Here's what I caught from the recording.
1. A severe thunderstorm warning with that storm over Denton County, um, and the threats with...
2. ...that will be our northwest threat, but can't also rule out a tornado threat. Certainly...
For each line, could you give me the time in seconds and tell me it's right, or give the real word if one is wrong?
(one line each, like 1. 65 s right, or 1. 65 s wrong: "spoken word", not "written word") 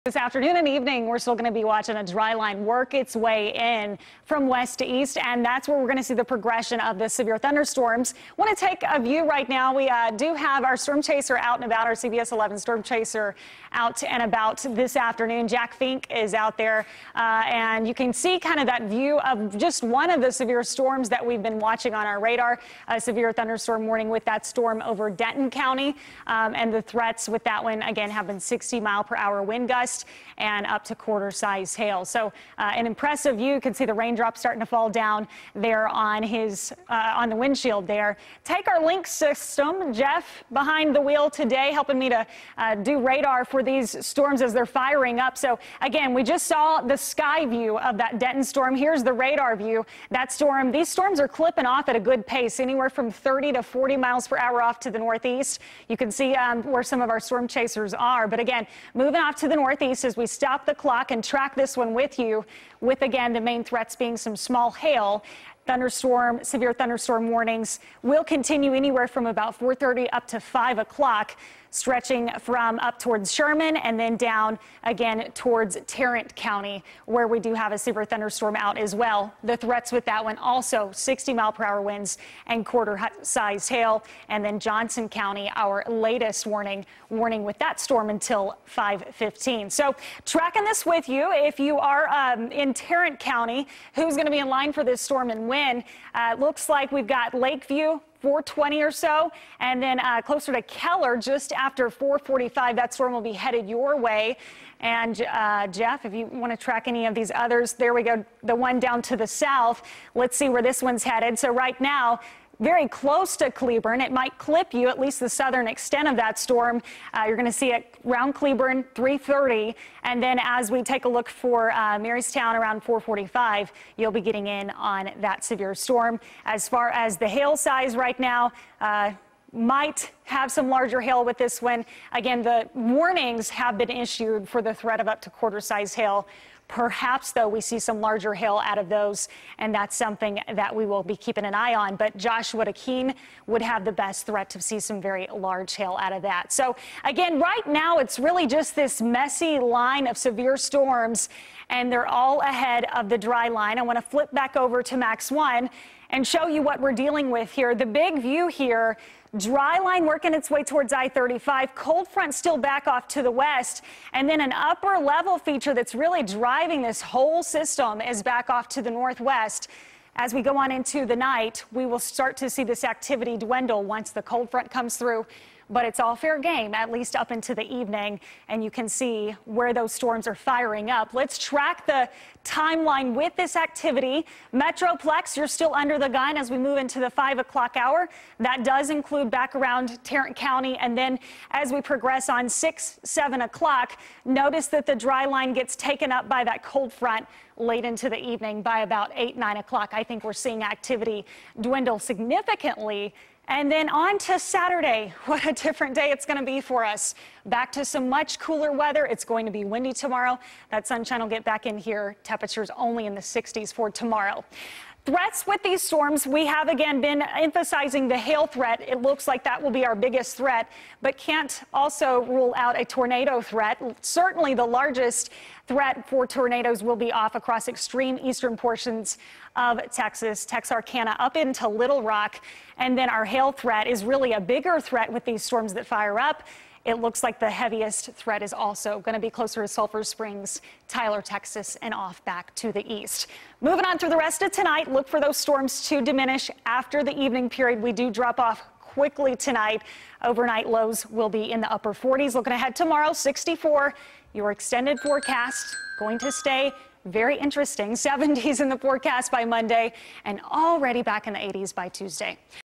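1. 22 s right
2. 219 s wrong: "biggest", not "northwest".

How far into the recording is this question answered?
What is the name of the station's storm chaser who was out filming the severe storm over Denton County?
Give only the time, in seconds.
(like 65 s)
15 s.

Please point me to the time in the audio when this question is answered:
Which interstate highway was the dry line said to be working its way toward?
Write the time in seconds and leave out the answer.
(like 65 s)
160 s.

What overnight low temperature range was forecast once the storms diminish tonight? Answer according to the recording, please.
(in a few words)
upper 40s.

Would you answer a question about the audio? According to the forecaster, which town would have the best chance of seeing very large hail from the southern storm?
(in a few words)
Joshua Keene.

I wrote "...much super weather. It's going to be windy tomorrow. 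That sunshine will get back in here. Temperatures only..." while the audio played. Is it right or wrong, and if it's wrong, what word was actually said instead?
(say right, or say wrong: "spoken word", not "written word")
wrong: "cooler", not "super".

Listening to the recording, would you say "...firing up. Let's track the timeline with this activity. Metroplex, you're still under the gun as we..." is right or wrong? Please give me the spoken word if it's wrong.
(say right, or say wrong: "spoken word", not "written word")
right.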